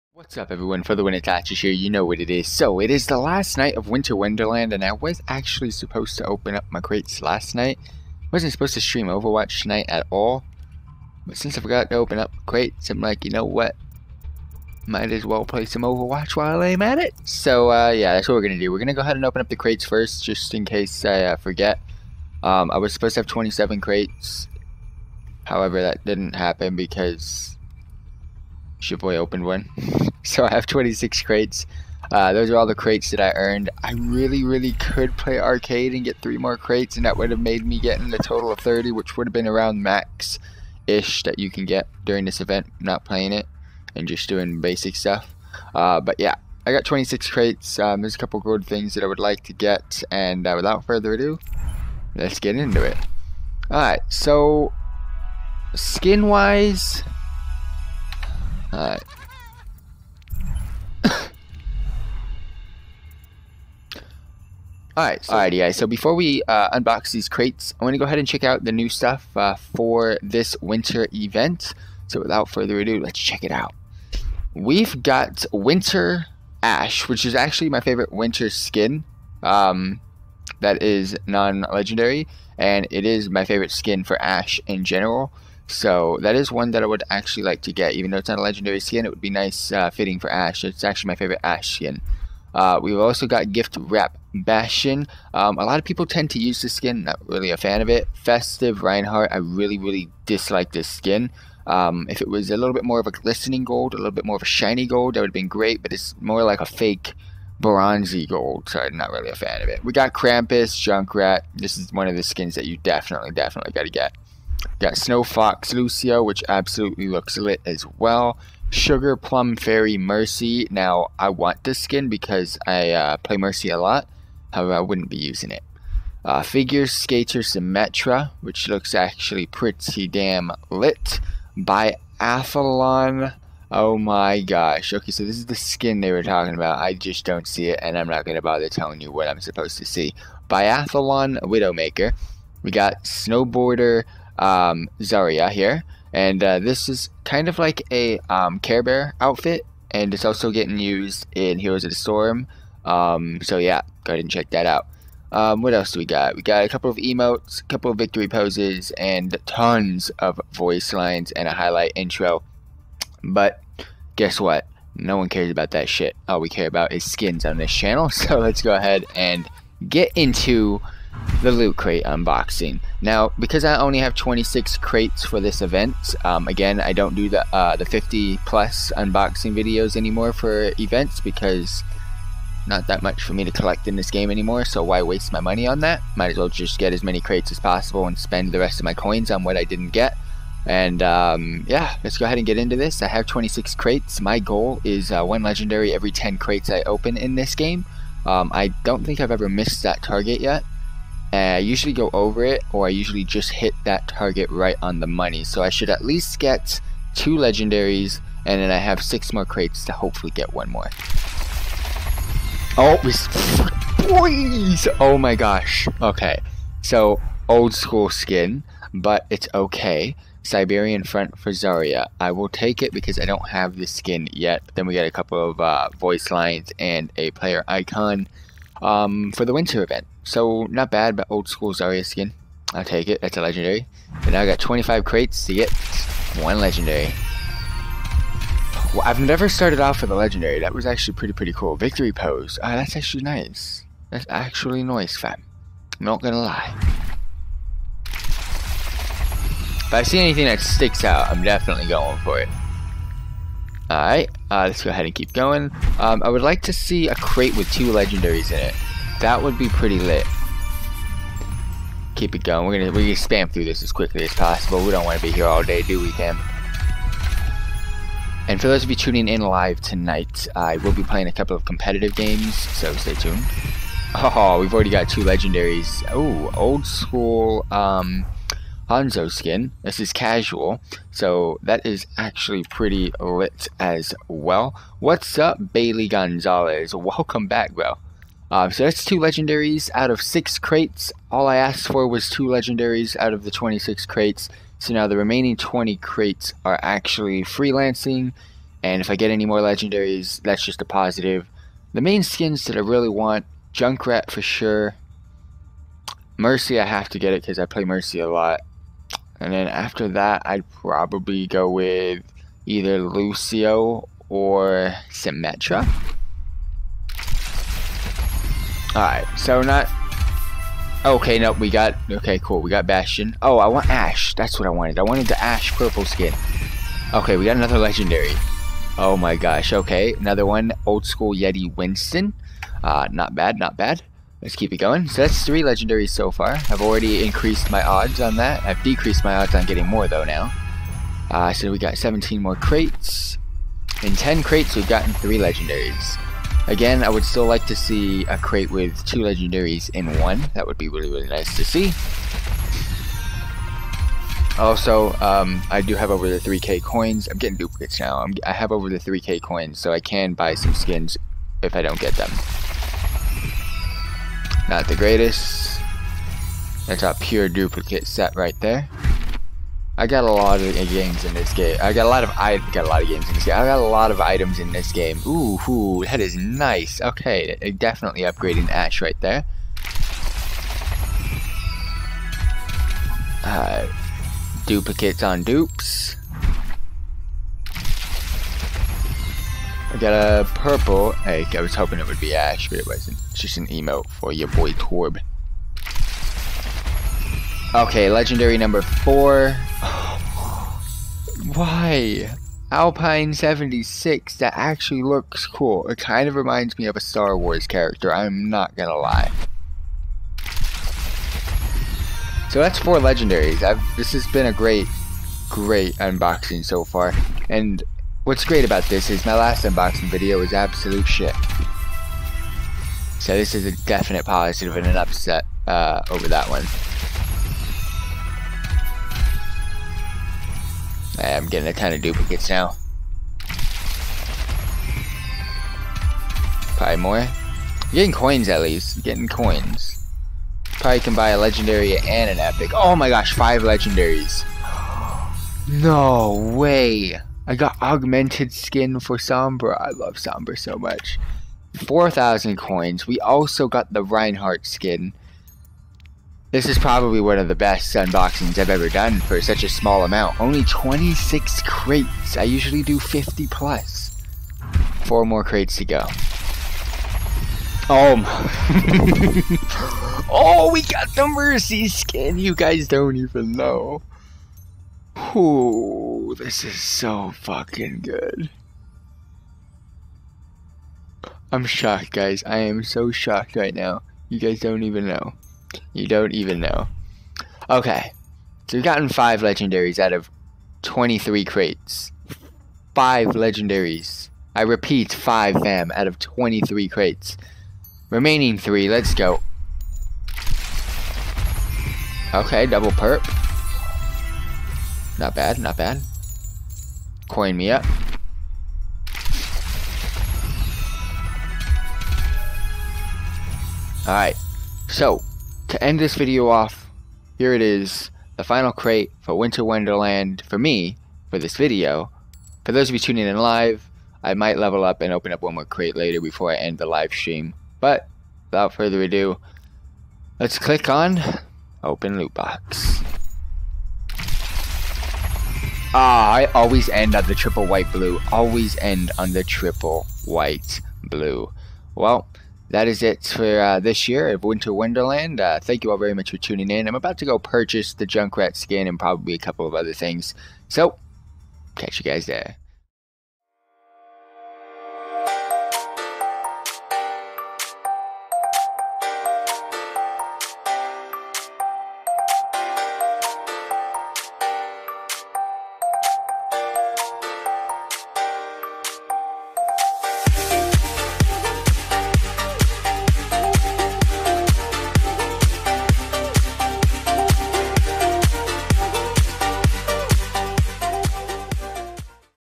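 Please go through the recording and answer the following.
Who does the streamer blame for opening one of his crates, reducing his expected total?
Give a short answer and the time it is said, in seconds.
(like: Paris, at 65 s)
Shipboy, at 28 s.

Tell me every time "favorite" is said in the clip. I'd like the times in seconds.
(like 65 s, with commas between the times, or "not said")
77 s, 83 s, 91 s.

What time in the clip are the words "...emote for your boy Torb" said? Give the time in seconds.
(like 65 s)
393 s.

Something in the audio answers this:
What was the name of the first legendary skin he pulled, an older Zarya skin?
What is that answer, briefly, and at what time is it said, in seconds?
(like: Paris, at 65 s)
Siberian Front, at 220 s.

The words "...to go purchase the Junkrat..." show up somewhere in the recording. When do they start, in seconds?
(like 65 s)
547 s.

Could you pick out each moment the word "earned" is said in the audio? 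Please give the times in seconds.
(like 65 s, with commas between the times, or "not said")
33 s.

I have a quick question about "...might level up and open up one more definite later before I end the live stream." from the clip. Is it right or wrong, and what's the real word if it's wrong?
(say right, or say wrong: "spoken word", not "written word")
wrong: "crate", not "definite".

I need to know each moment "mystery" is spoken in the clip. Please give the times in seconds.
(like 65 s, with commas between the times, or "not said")
not said.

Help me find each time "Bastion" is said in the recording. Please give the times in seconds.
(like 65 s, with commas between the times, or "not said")
94 s, 322 s.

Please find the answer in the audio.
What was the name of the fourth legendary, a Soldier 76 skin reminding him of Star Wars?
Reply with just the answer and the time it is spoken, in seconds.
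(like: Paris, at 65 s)
Alpine 76, at 402 s.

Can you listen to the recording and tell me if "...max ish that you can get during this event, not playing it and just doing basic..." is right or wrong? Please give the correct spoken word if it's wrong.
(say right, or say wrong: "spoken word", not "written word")
right.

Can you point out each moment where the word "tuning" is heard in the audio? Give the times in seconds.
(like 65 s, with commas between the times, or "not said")
268 s, 522 s, 546 s.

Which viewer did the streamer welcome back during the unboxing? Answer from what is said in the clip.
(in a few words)
Bailey Gonzalez.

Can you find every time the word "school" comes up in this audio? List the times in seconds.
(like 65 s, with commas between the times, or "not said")
217 s, 231 s, 276 s, 331 s.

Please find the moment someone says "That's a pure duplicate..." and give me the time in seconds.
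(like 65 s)
366 s.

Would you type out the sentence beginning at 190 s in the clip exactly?
And um, yeah, let's go ahead and get into this.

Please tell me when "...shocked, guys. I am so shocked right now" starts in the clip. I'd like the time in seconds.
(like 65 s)
481 s.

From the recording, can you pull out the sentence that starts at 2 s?
So, it is the last night of Winter Wonderland, and I was actually supposed to open up my crates last night.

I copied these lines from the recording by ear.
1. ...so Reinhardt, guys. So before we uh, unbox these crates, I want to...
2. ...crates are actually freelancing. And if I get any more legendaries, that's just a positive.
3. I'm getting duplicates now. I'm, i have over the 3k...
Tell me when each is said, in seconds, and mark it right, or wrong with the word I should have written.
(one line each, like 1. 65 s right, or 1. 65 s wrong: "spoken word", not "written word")
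1. 65 s wrong: "Alrighty", not "Reinhardt"
2. 295 s right
3. 357 s right.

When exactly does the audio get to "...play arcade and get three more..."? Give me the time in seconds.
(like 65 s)
35 s.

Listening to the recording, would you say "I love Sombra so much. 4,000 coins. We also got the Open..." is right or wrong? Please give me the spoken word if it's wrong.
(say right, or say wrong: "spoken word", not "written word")
wrong: "Reinhardt", not "Open".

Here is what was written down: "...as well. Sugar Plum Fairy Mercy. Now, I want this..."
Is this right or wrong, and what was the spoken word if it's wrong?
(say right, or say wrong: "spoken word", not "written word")
right.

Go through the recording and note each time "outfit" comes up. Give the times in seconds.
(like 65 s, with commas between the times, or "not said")
149 s.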